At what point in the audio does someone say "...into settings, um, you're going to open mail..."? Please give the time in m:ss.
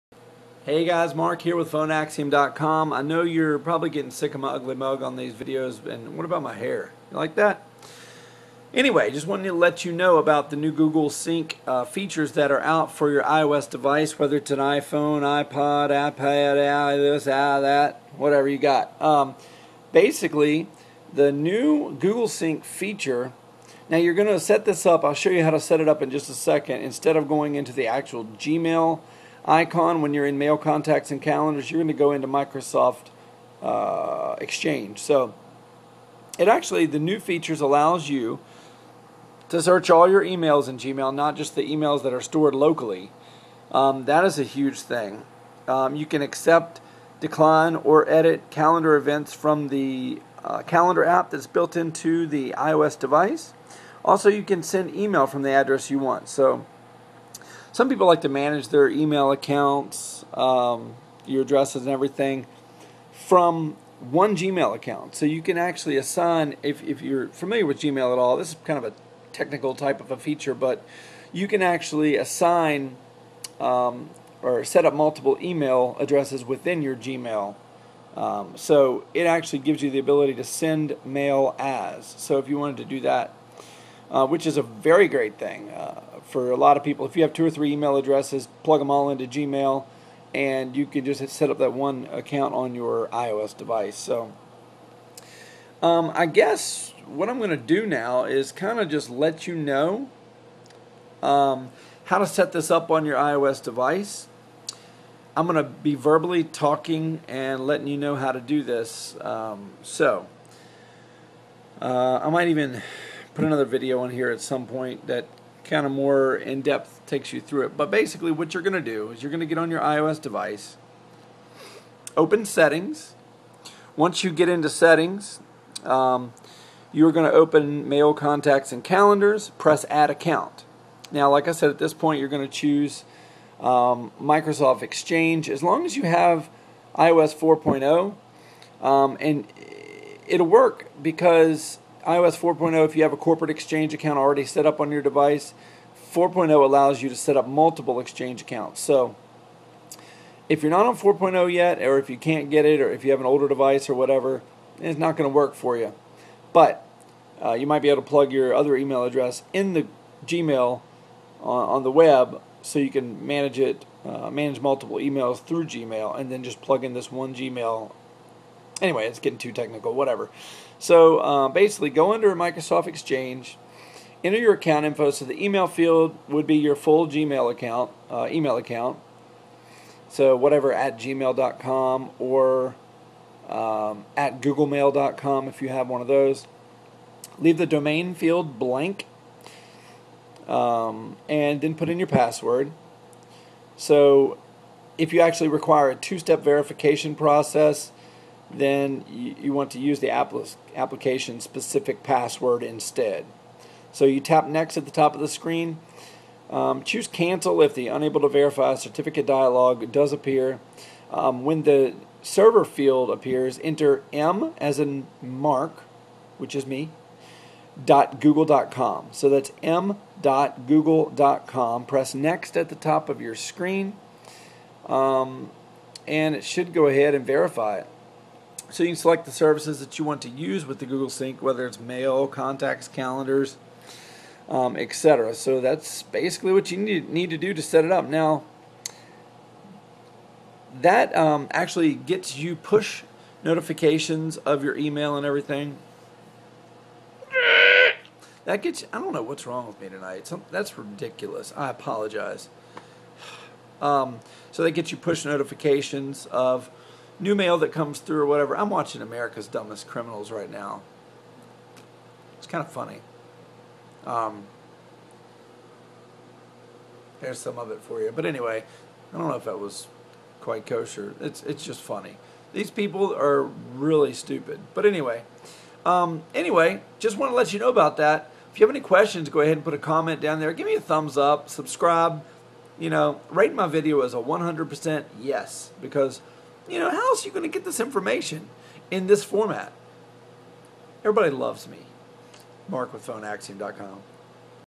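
2:04.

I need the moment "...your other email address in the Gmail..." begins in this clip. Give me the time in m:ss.
2:38.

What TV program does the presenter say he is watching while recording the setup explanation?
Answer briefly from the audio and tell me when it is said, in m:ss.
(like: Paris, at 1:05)
America's Dumbest Criminals, at 4:19.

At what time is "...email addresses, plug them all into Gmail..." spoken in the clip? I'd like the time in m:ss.
1:27.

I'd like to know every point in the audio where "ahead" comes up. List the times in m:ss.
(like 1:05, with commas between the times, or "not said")
3:46, 4:39.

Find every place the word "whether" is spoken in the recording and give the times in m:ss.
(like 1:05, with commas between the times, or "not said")
0:14, 3:51.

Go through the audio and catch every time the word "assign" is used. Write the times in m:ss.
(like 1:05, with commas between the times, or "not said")
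1:05, 1:12.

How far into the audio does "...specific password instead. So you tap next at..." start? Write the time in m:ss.
3:21.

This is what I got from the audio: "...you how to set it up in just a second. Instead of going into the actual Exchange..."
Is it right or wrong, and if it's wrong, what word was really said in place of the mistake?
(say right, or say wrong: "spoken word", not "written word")
wrong: "Gmail", not "Exchange".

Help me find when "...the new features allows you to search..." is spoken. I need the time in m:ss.
0:36.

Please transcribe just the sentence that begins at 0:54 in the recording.
Also, you can send email from the address you want.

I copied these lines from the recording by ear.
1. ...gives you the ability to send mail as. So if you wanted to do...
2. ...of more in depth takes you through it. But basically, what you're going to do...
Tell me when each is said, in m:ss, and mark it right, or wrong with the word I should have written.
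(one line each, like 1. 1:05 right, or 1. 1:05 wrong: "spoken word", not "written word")
1. 1:19 right
2. 1:55 right.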